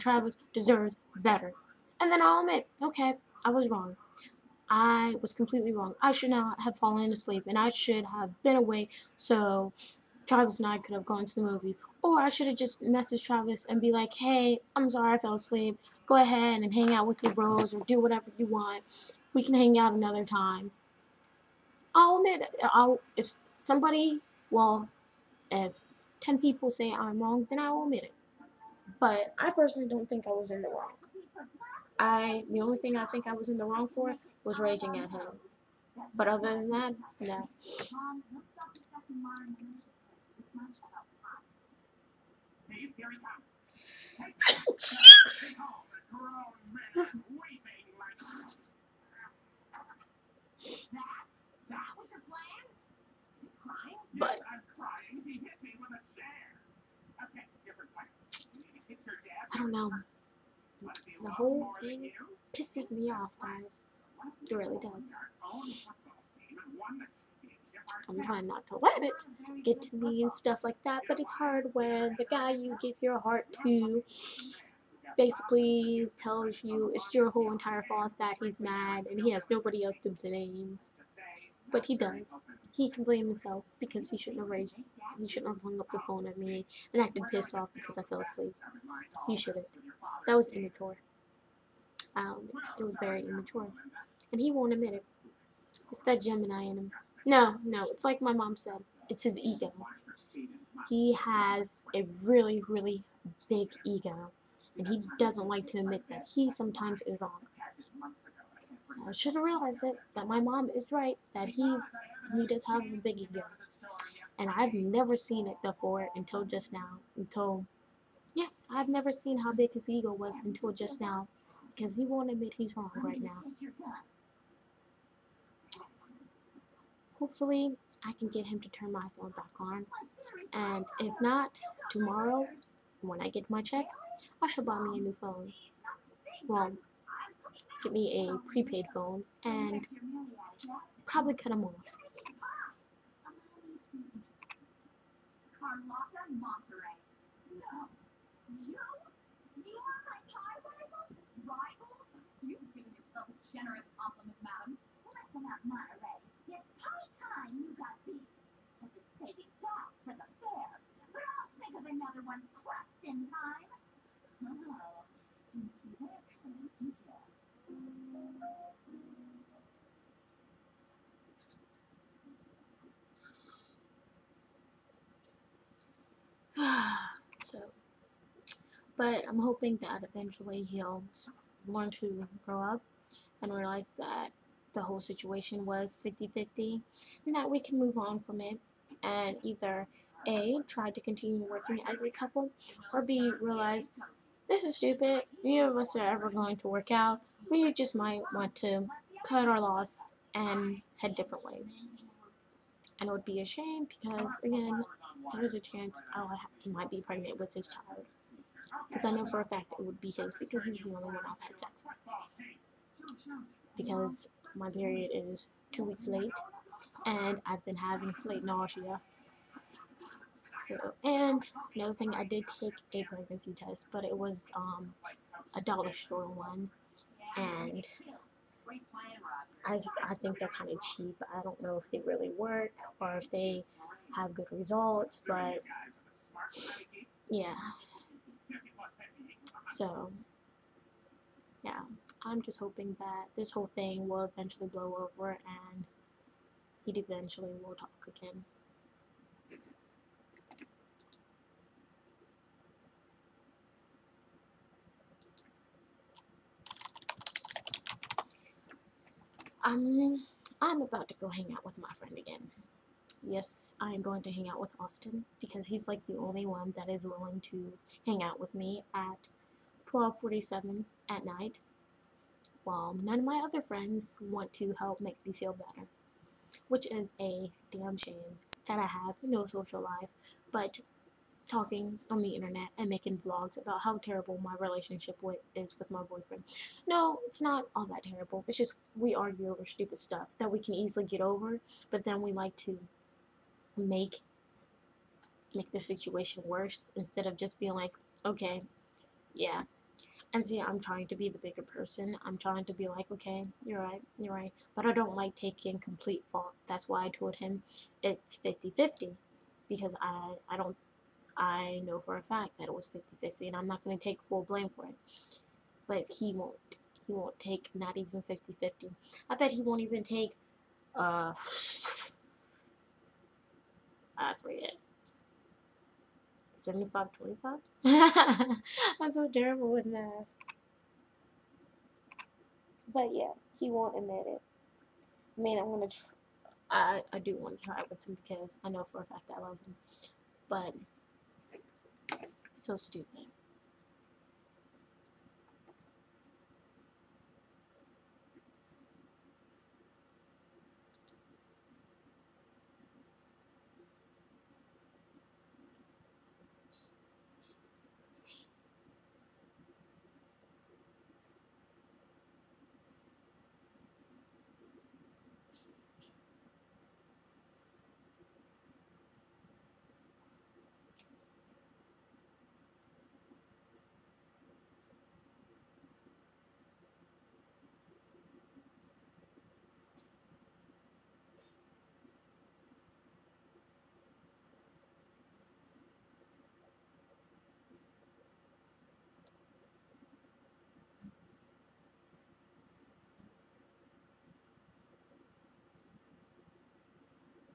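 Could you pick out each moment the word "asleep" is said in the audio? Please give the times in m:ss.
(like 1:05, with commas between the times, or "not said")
0:07, 0:15, 1:28.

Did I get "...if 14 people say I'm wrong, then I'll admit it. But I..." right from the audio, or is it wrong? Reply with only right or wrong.
wrong.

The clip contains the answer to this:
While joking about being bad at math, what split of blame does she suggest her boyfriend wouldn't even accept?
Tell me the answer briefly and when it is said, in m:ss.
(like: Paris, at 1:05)
75-25, at 5:26.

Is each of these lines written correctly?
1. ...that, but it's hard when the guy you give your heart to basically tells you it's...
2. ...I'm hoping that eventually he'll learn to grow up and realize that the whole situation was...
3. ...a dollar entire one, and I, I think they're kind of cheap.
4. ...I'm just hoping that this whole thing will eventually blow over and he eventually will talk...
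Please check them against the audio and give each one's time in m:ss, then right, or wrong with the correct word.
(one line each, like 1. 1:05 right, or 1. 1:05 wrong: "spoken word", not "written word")
1. 1:10 right
2. 2:59 right
3. 3:45 wrong: "store", not "entire"
4. 4:02 right.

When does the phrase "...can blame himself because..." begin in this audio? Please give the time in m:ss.
1:22.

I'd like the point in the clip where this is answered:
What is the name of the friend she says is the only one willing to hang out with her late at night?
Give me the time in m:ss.
4:24.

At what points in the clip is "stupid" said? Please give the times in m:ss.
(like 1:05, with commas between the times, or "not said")
3:14, 4:49, 5:42.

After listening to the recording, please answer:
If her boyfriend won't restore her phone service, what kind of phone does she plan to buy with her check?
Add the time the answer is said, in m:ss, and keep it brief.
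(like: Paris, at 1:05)
Prepaid phone, at 2:18.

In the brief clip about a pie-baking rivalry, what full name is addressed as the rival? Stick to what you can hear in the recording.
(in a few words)
Carlotta Monterey.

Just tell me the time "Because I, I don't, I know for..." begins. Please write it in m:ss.
5:09.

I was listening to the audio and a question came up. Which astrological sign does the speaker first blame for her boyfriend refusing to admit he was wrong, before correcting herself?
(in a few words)
Gemini.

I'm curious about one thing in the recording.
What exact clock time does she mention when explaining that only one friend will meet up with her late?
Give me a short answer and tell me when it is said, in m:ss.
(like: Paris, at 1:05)
12:47, at 4:29.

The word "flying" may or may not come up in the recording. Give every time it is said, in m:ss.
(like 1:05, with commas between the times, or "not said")
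not said.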